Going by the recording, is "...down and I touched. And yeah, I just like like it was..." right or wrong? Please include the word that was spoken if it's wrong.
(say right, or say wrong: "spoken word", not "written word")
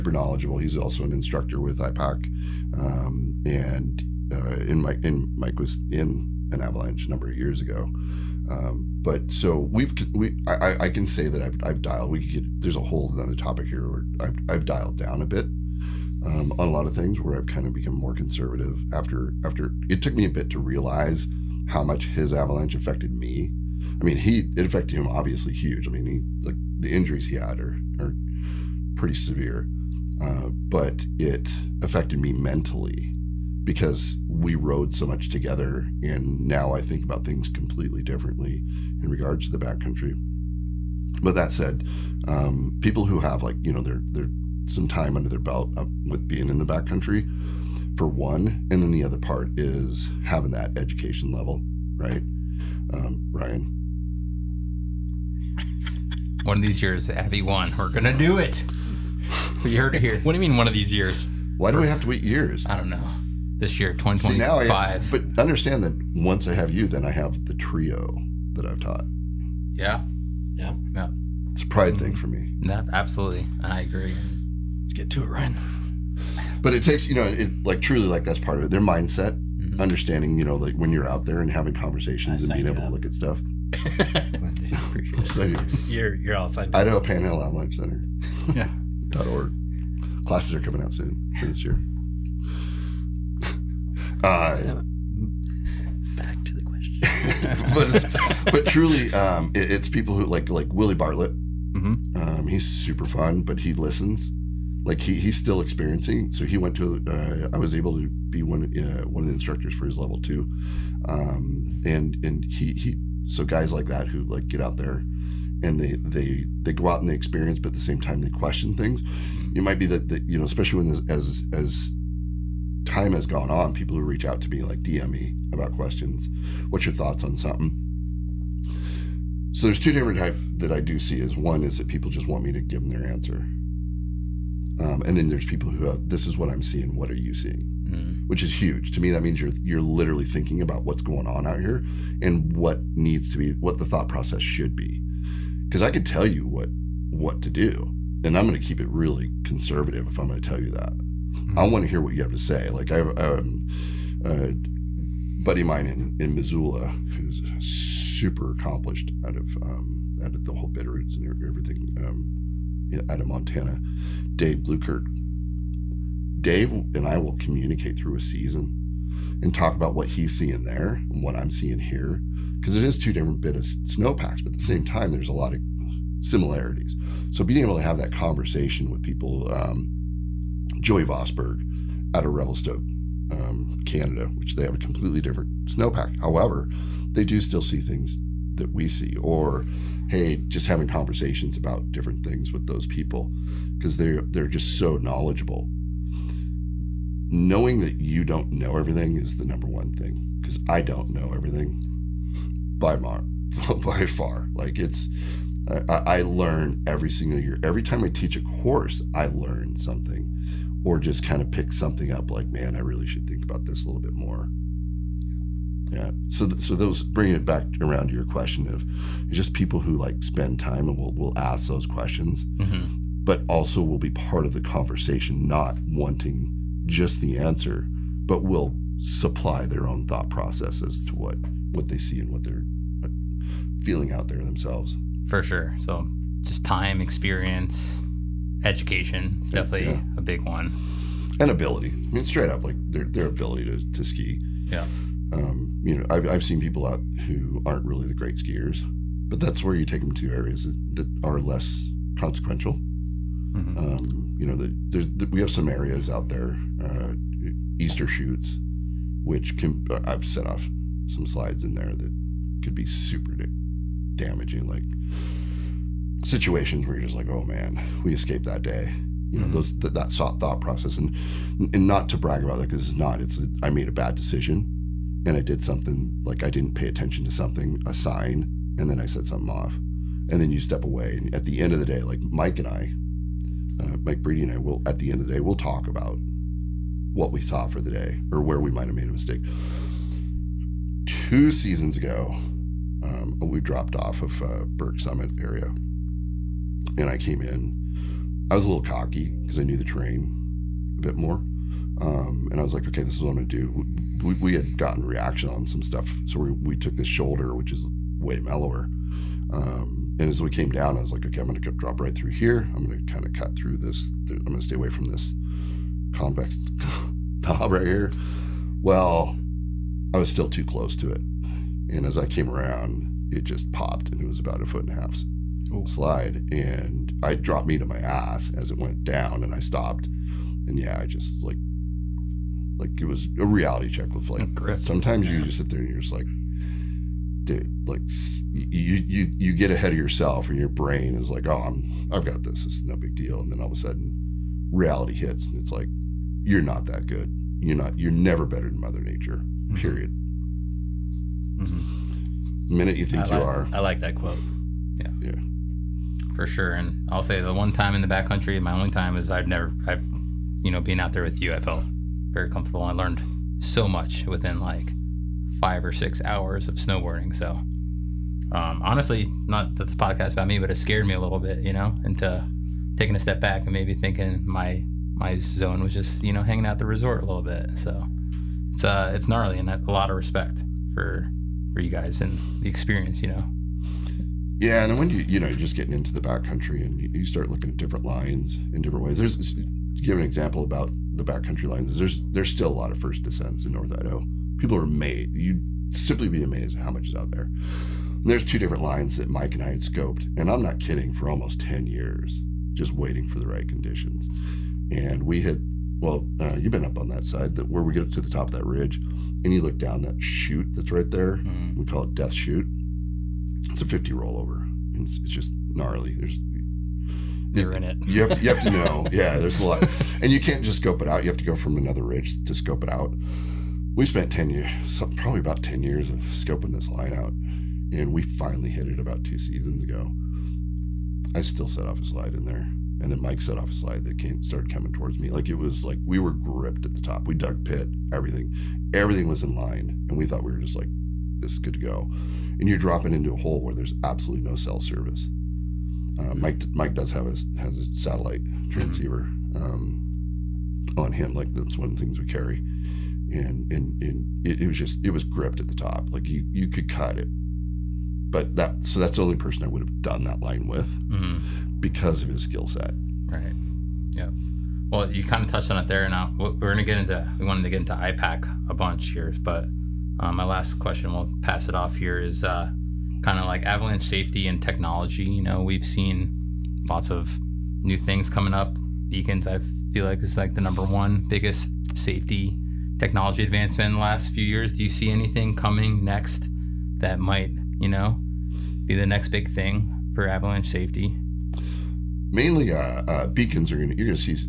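wrong: "stopped", not "touched".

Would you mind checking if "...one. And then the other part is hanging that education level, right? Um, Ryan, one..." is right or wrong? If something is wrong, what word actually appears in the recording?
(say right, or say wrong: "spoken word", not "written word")
wrong: "having", not "hanging".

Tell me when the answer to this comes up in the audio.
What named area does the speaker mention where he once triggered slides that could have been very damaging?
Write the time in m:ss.
4:17.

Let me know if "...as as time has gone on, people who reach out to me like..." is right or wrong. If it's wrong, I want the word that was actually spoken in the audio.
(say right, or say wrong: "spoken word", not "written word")
right.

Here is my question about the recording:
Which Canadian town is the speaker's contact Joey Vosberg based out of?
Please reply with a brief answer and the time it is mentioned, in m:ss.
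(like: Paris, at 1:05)
Revelstoke, at 3:02.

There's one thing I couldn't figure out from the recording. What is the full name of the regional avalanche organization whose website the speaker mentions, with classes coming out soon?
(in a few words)
Idaho Panhandle Center.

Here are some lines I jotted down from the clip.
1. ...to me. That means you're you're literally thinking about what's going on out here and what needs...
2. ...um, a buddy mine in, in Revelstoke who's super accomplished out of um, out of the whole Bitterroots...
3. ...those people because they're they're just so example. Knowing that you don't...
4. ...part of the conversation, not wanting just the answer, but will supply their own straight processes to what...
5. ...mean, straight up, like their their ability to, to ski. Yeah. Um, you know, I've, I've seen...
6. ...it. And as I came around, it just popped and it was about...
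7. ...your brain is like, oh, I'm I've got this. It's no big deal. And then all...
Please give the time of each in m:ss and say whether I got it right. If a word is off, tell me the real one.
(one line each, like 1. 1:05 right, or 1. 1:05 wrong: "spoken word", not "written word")
1. 2:18 right
2. 2:33 wrong: "Missoula", not "Revelstoke"
3. 3:12 wrong: "knowledgeable", not "example"
4. 3:44 wrong: "thought", not "straight"
5. 4:02 right
6. 5:21 right
7. 5:40 right.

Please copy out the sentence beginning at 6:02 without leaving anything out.
I learned so much within like five or six hours of snowboarding.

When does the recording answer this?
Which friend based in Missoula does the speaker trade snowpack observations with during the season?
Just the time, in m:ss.
2:44.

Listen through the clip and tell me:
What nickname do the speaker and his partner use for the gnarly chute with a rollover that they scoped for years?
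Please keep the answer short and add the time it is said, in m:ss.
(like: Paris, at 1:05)
Death Chute, at 6:52.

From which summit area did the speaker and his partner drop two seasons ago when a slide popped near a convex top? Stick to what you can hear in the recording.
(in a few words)
Burke Summit.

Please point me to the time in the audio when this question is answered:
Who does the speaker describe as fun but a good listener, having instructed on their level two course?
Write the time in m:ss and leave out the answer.
1:40.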